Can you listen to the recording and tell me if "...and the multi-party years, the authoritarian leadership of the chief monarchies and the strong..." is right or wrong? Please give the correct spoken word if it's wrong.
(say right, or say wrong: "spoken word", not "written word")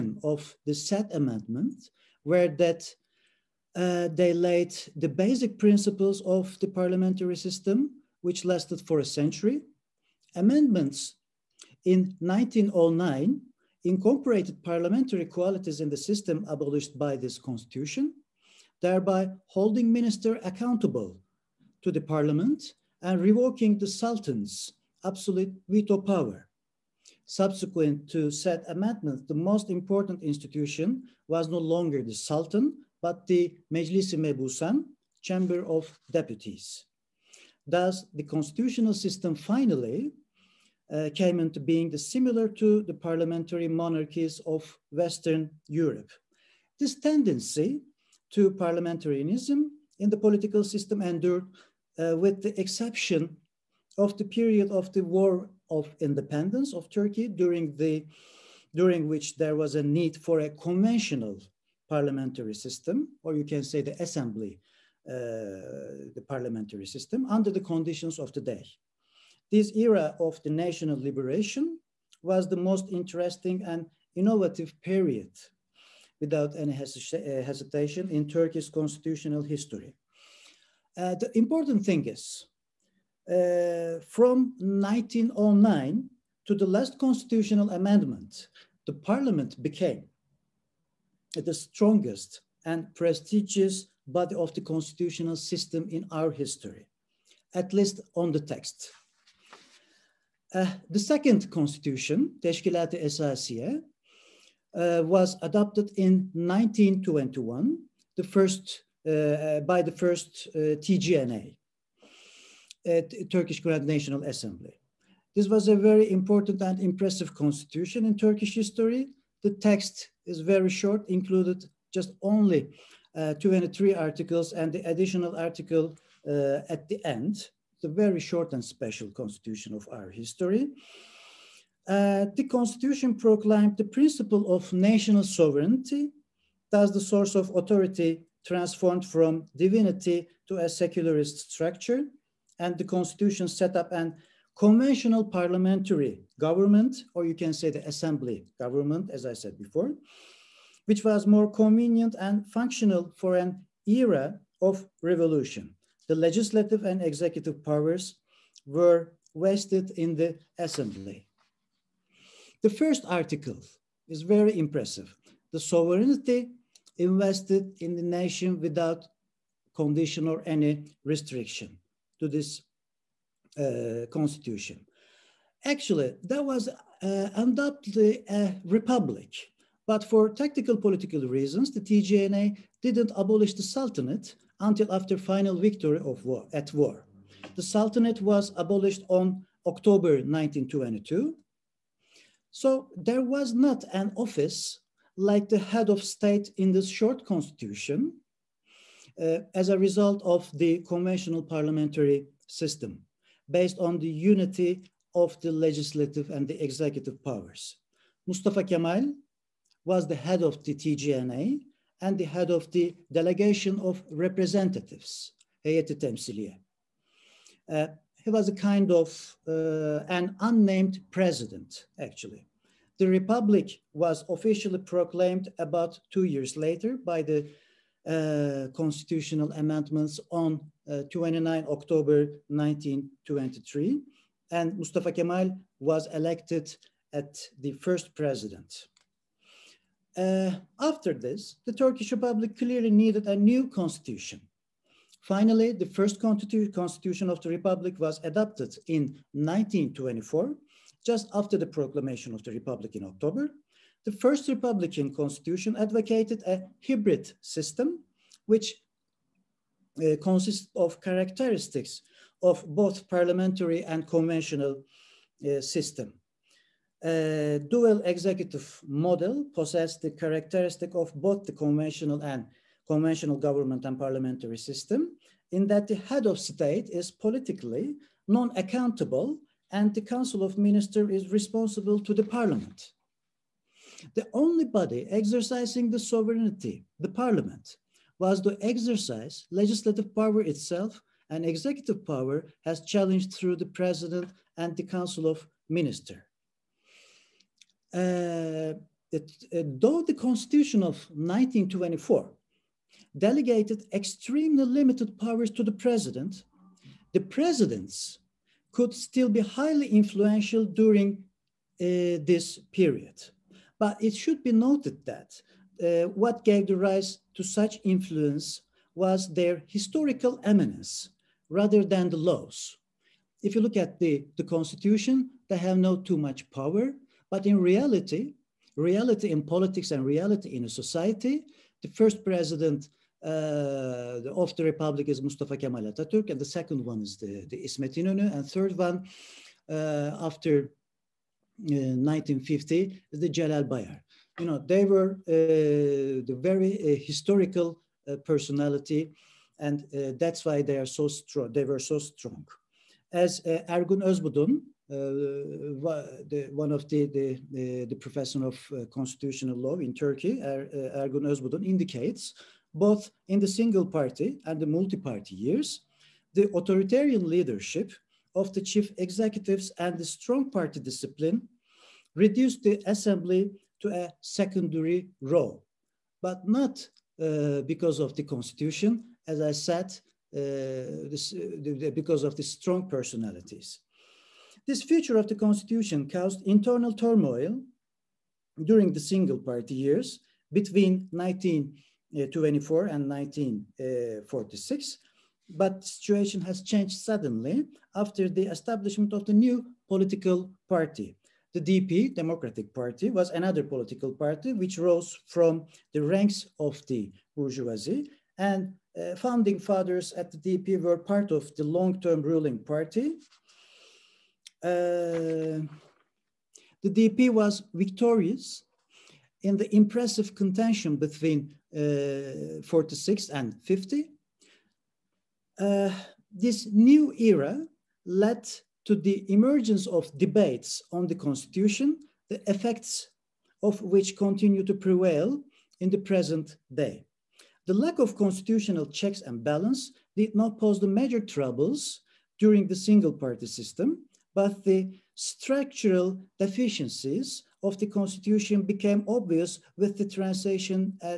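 wrong: "executives", not "monarchies".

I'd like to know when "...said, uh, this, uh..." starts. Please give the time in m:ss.
6:19.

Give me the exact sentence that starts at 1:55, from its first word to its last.
This was a very important and impressive constitution in Turkish history.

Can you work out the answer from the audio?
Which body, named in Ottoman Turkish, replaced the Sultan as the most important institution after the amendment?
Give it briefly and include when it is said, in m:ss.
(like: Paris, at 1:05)
Meclis-i Mebusan, at 0:33.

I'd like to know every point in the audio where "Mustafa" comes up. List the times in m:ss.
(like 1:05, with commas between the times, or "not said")
3:28, 3:54, 5:35.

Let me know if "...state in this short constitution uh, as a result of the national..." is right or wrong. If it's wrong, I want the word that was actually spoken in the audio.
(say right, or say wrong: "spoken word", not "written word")
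wrong: "conventional", not "national".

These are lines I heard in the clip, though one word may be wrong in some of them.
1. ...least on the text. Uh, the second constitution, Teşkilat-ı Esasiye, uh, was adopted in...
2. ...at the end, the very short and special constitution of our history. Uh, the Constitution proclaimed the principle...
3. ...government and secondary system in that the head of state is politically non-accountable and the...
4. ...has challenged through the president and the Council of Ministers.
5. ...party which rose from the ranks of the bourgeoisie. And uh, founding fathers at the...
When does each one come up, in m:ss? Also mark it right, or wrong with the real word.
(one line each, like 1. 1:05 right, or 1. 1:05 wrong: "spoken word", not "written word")
1. 1:37 right
2. 2:06 right
3. 4:33 wrong: "parliamentary", not "secondary"
4. 4:52 right
5. 6:44 right.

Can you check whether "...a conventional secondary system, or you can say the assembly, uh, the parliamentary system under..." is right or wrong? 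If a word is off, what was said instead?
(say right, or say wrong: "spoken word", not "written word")
wrong: "parliamentary", not "secondary".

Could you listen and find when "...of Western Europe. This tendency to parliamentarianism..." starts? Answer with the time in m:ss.
0:44.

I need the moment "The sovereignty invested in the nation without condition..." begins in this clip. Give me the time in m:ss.
2:45.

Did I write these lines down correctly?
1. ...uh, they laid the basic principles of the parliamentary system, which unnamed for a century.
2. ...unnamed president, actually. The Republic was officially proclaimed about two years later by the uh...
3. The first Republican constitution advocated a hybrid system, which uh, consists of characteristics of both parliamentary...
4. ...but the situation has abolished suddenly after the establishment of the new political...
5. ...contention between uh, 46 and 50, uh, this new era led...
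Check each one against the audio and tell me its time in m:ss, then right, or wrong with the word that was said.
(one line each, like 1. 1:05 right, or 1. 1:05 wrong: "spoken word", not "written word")
1. 0:03 wrong: "lasted", not "unnamed"
2. 3:40 right
3. 4:14 right
4. 6:35 wrong: "changed", not "abolished"
5. 7:00 right.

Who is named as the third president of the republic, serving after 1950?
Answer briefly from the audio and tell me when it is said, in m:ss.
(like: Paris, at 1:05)
Celal Bayar, at 5:43.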